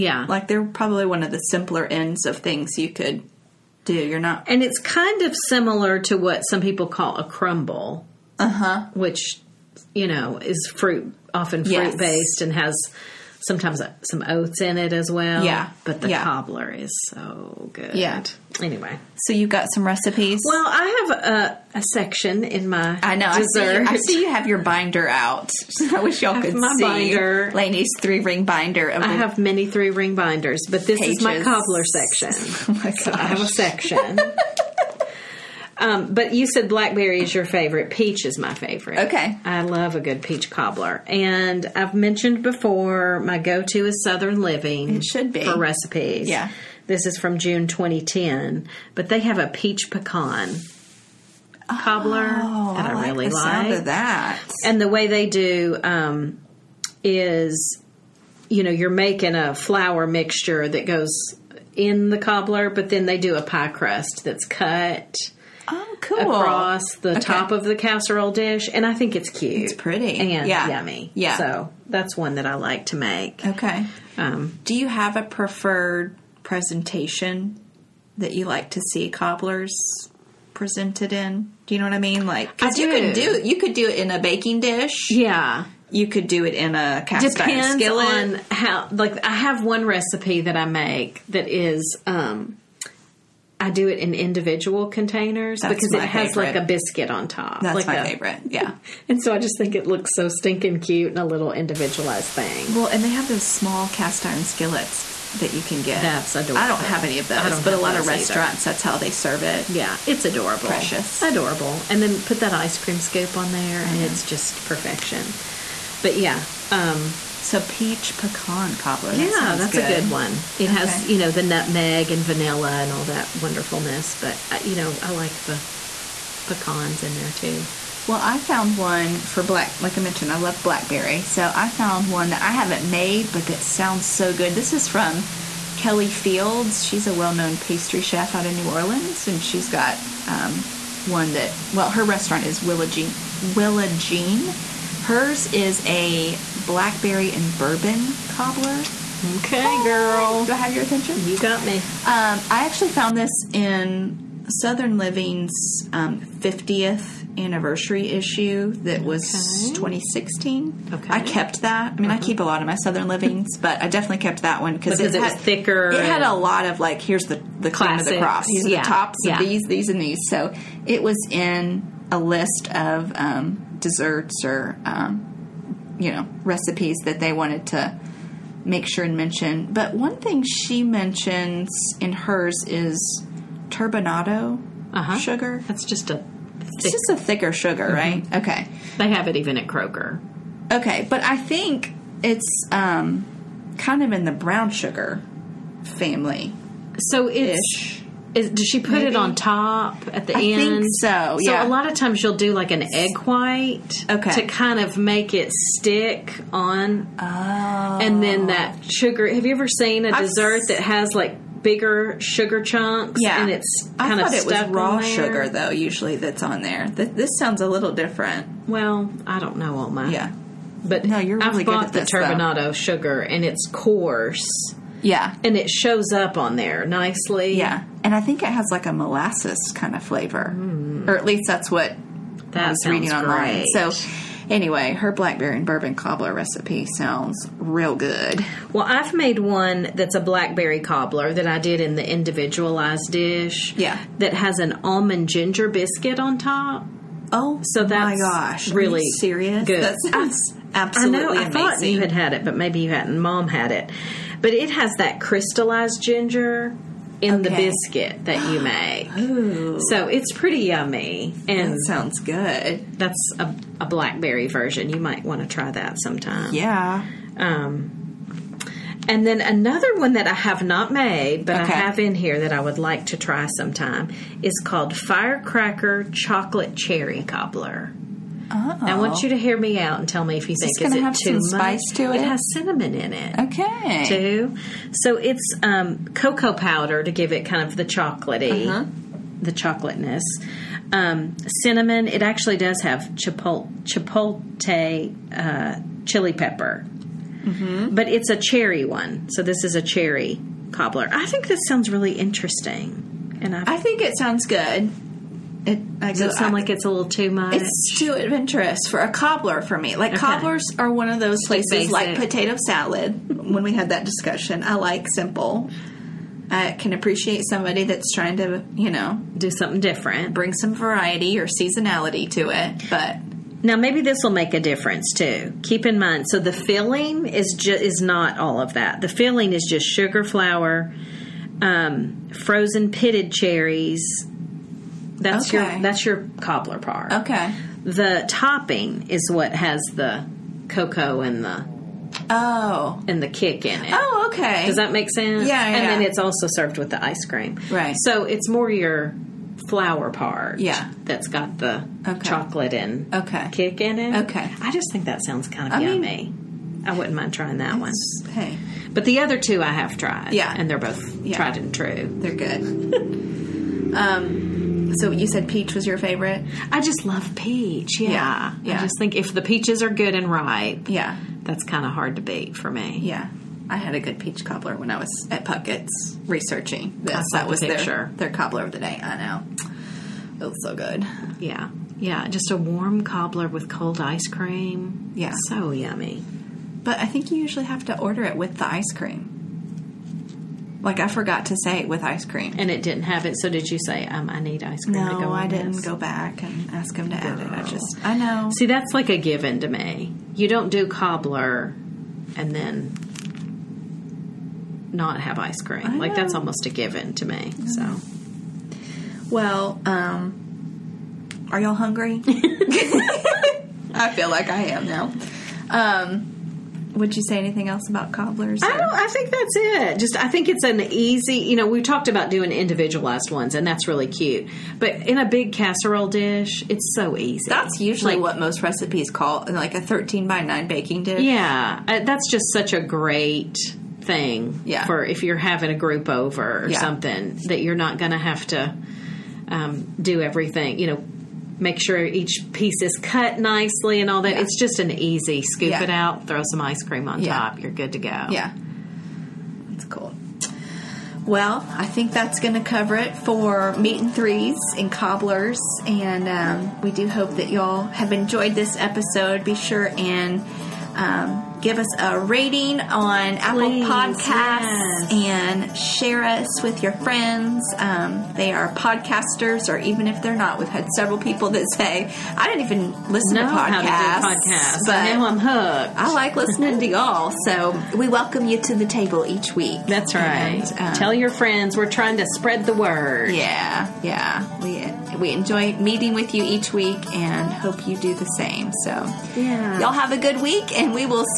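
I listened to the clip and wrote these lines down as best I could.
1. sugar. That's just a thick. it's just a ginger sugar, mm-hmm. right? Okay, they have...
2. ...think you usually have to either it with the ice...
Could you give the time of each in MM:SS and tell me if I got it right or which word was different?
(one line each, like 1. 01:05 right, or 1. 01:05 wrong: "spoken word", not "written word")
1. 03:05 wrong: "thicker", not "ginger"
2. 06:27 wrong: "order", not "either".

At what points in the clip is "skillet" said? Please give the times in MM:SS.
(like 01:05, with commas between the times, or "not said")
01:27, 01:44.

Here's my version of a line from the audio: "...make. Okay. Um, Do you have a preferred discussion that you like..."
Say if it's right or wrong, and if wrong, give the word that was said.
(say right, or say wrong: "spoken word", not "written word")
wrong: "presentation", not "discussion".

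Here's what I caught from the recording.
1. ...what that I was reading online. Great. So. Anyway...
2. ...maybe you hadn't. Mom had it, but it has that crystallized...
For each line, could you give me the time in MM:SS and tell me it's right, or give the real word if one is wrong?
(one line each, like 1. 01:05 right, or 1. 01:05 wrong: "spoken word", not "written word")
1. 03:51 right
2. 04:12 right.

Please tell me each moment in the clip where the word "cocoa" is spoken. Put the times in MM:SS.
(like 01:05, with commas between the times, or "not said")
04:46, 05:40.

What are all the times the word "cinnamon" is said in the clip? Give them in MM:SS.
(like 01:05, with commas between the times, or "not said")
04:42, 04:51.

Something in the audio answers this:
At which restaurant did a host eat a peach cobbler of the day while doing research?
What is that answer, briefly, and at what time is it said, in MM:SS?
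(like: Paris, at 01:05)
Puckett's, at 06:15.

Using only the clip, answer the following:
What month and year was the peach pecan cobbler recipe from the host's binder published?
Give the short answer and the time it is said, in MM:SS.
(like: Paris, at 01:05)
June 2010, at 00:47.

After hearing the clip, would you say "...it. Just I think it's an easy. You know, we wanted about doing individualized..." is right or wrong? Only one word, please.
wrong.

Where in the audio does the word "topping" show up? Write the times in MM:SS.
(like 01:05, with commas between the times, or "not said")
05:38.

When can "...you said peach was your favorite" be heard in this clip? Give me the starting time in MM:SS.
06:05.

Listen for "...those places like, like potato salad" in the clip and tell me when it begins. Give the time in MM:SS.
05:11.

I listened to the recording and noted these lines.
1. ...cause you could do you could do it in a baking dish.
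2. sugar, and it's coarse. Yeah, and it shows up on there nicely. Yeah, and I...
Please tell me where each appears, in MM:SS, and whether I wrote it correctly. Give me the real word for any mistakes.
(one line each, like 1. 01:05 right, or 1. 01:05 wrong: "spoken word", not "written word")
1. 01:22 right
2. 03:42 right.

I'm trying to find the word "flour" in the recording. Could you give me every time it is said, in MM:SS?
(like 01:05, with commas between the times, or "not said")
00:59, 05:30, 05:49.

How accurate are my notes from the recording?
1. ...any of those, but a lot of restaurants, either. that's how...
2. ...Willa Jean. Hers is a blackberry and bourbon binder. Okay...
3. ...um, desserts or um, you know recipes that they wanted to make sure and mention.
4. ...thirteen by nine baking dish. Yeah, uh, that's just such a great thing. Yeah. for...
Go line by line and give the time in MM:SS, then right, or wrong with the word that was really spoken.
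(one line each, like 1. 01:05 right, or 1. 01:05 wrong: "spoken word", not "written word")
1. 01:47 right
2. 02:23 wrong: "cobbler", not "binder"
3. 02:53 right
4. 07:09 right.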